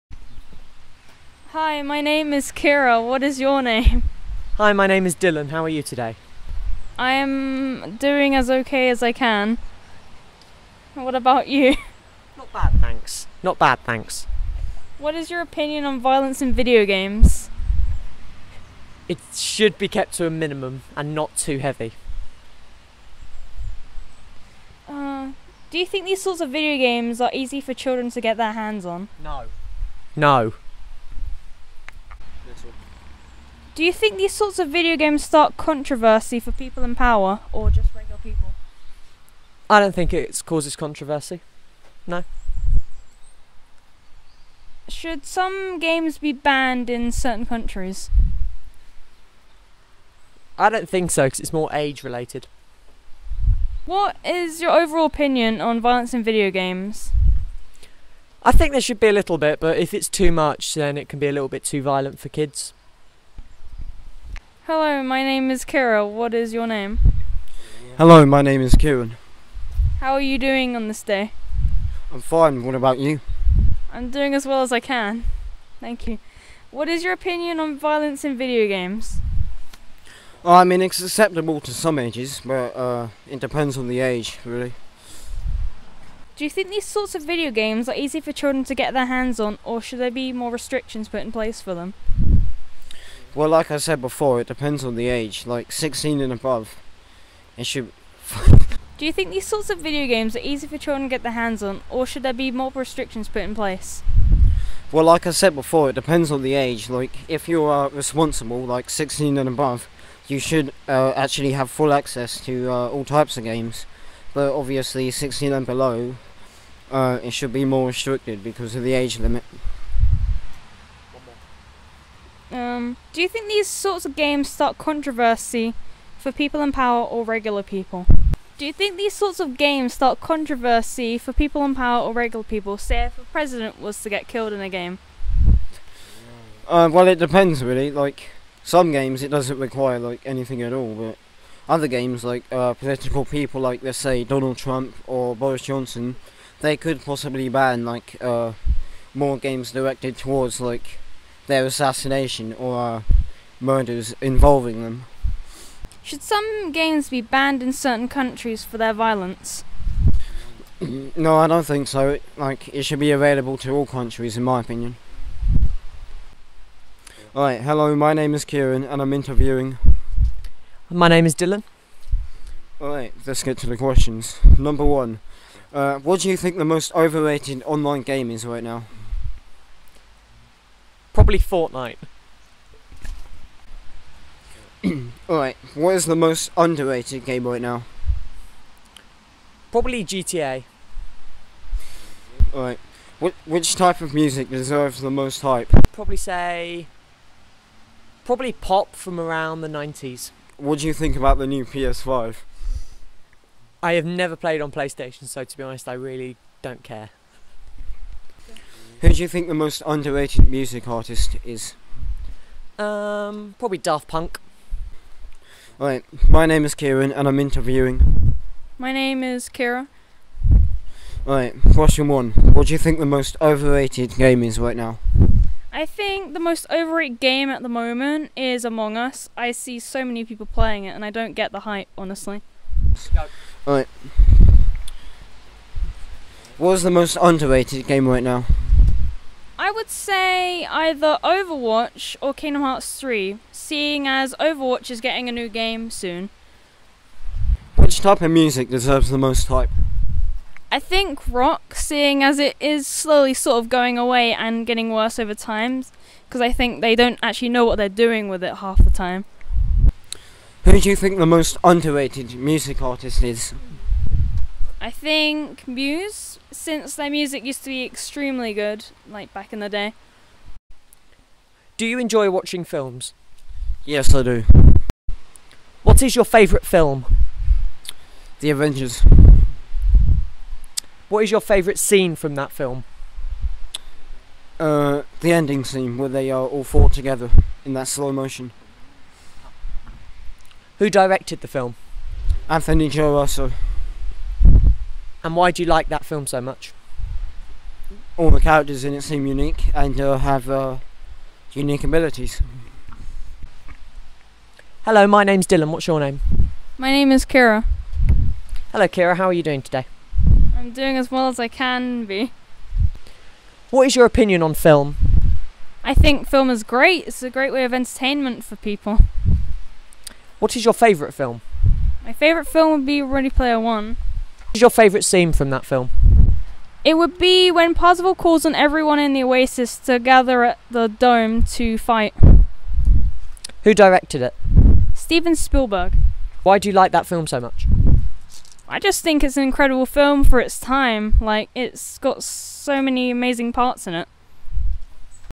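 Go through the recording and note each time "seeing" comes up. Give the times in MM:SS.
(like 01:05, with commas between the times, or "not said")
04:03, 04:11.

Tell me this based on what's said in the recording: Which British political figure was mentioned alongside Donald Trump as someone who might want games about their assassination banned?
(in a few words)
Boris Johnson.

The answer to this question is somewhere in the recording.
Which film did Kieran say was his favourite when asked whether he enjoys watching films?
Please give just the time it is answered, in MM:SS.
04:38.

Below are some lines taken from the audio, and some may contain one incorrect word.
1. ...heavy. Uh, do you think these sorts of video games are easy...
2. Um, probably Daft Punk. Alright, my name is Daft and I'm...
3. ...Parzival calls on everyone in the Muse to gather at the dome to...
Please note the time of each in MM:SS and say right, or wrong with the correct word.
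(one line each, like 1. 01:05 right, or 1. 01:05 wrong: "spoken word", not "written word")
1. 00:21 right
2. 03:32 wrong: "Kieran", not "Daft"
3. 05:27 wrong: "Oasis", not "Muse".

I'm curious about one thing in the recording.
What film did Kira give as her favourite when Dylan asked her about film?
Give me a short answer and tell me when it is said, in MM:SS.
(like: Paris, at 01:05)
Ready Player One, at 05:23.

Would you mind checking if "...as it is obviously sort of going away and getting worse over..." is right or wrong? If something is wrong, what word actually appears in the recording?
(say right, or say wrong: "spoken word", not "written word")
wrong: "slowly", not "obviously".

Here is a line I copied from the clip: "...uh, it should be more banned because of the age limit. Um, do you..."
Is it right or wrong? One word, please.
wrong.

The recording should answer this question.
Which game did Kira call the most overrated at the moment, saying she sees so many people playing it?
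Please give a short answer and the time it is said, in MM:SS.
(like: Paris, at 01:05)
Among Us, at 03:48.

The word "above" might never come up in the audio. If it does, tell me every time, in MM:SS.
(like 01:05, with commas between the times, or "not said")
01:36, 01:49.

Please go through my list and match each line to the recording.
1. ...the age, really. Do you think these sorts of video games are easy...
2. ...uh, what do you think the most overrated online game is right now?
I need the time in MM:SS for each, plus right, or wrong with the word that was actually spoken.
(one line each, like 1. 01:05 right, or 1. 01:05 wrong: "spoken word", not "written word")
1. 01:23 right
2. 02:55 right.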